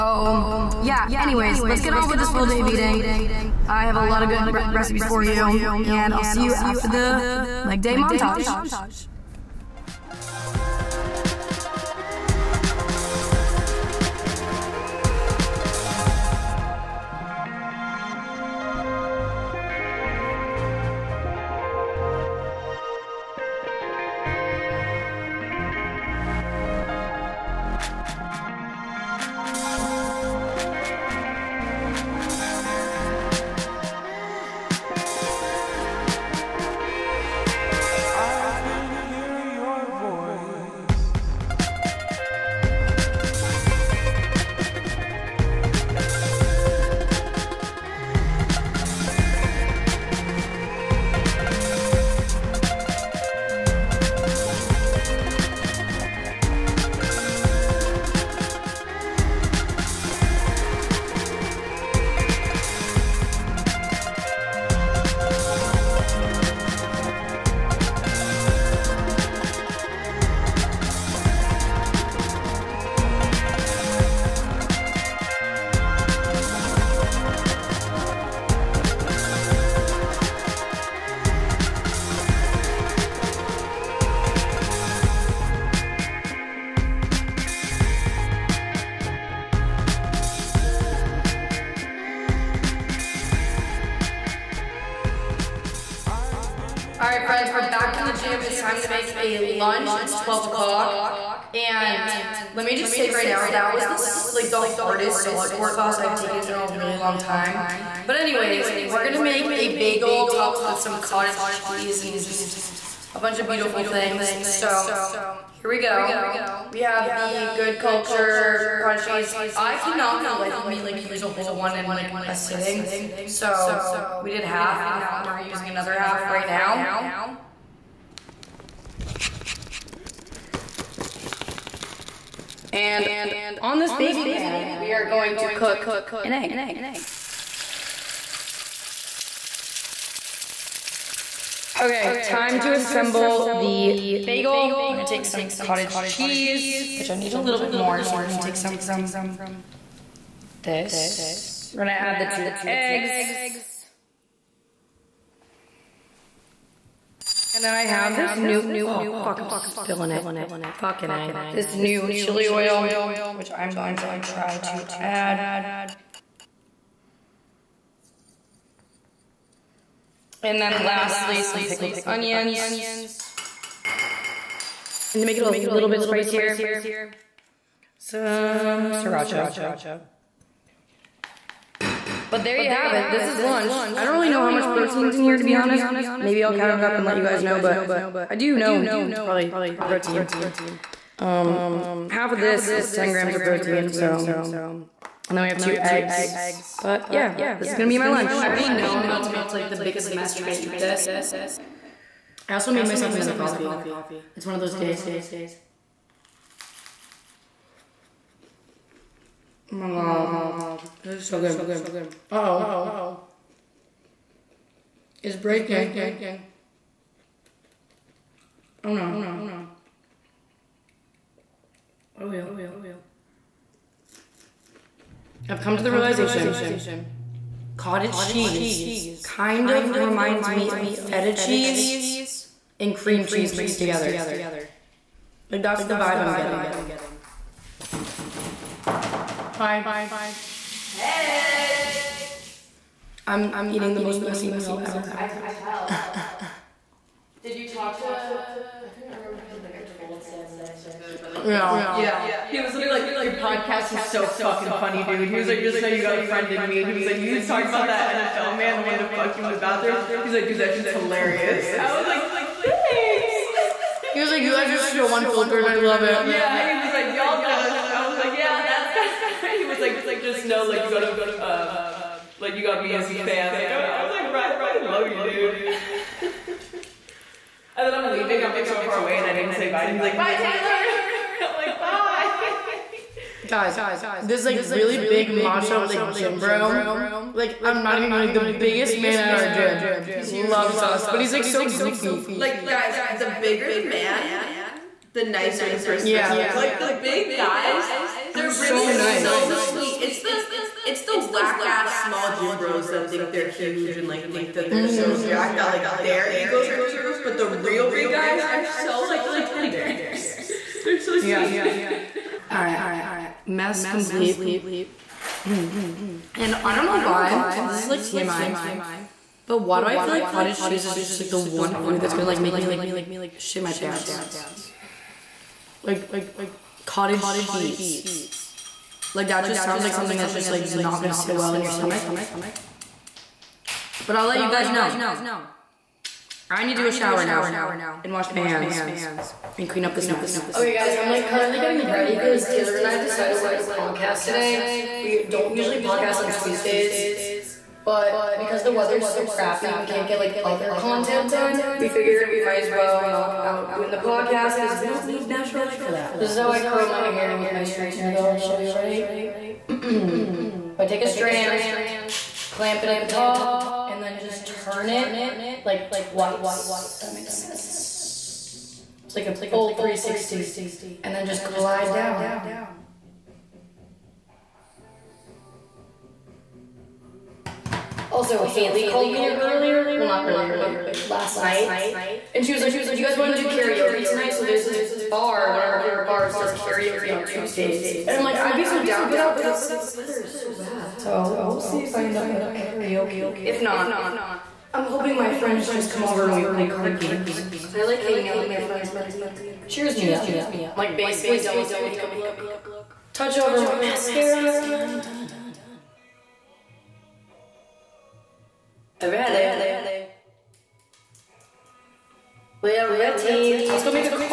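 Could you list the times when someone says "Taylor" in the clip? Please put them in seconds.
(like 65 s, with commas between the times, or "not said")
281 s, 342 s.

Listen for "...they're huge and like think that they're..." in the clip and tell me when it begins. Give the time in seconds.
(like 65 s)
303 s.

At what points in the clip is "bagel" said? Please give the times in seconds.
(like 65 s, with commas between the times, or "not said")
109 s, 144 s.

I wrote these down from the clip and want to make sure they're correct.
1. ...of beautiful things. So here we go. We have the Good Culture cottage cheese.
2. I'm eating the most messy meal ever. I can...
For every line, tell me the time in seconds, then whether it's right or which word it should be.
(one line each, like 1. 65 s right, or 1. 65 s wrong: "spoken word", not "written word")
1. 113 s right
2. 243 s right.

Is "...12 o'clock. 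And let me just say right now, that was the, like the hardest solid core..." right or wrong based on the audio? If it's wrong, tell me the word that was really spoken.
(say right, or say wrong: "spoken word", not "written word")
right.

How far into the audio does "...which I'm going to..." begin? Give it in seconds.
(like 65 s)
163 s.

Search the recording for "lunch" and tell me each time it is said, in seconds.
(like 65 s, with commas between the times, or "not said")
99 s, 183 s, 198 s.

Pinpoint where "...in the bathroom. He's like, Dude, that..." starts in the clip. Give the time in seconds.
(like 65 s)
259 s.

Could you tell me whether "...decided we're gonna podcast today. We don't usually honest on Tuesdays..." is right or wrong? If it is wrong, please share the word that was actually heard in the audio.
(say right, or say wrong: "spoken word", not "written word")
wrong: "podcast", not "honest".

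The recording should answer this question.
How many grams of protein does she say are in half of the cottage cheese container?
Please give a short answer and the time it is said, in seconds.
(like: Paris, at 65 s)
10, at 192 s.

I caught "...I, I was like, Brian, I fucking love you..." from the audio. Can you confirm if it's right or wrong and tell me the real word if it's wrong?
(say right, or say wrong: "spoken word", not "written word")
right.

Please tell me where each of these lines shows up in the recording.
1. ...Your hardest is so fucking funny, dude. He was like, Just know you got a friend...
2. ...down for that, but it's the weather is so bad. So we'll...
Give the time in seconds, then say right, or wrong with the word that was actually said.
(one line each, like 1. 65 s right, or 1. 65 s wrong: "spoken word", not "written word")
1. 253 s wrong: "podcast", not "hardest"
2. 388 s right.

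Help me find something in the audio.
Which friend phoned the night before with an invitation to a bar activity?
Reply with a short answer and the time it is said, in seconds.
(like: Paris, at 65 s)
Haley, at 378 s.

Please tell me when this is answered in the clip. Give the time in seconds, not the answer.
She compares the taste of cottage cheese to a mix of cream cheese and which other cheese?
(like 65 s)
230 s.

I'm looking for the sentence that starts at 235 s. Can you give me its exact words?
Like that's the vibe I'm getting.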